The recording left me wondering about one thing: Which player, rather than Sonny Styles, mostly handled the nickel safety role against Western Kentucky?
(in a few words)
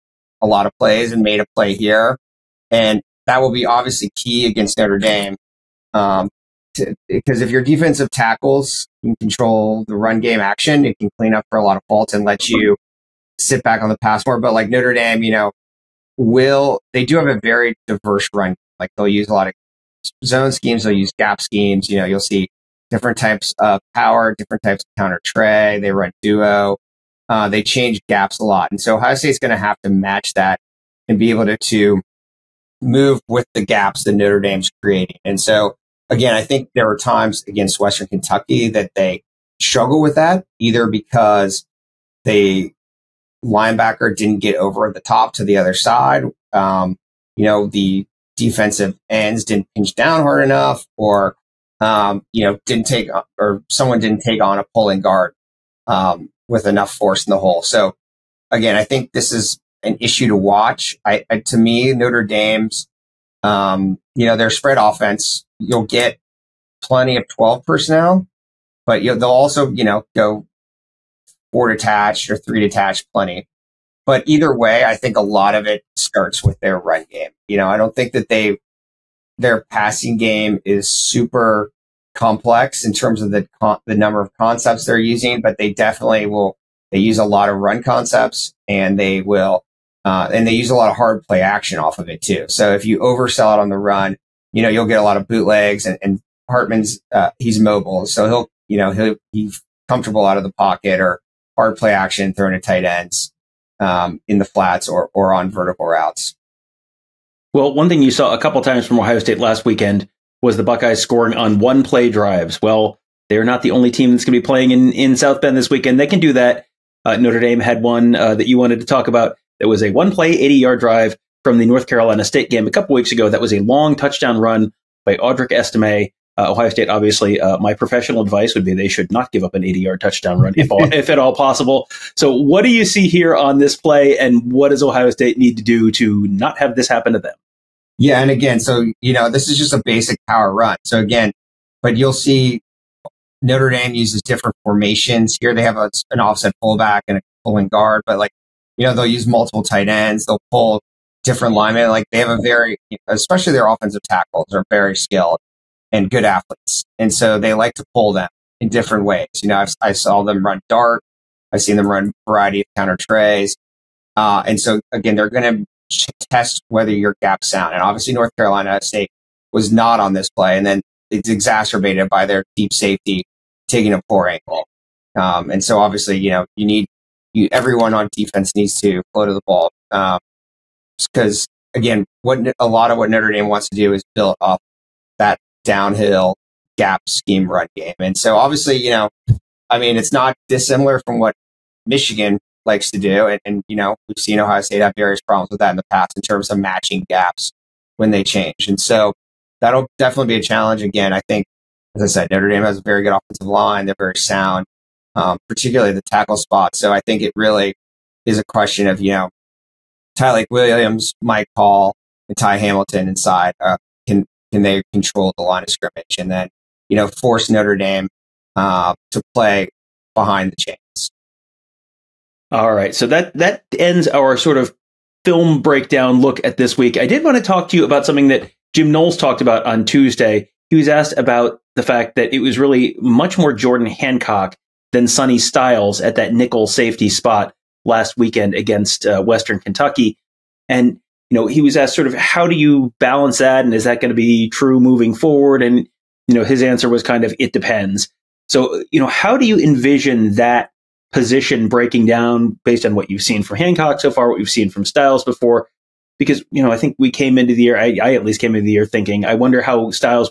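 Jordan Hancock.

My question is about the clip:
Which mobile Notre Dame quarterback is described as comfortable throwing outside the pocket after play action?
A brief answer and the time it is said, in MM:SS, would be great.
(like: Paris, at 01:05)
Hartman, at 01:36.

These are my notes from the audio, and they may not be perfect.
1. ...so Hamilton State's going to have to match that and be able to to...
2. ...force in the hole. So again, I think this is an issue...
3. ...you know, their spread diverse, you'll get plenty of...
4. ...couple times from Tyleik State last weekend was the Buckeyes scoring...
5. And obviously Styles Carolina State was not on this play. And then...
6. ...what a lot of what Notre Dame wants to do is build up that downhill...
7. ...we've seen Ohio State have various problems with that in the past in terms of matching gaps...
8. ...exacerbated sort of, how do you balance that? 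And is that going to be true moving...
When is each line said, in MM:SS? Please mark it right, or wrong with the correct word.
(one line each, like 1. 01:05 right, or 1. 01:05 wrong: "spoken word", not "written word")
1. 00:28 wrong: "Ohio", not "Hamilton"
2. 00:56 right
3. 01:04 wrong: "offense", not "diverse"
4. 01:48 wrong: "Ohio", not "Tyleik"
5. 02:47 wrong: "North", not "Styles"
6. 03:02 right
7. 03:14 right
8. 04:01 wrong: "asked", not "exacerbated".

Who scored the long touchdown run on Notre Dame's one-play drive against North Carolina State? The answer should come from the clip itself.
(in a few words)
Audric Estime.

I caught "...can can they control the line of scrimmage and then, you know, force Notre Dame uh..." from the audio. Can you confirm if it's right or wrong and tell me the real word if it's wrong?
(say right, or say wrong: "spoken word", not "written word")
right.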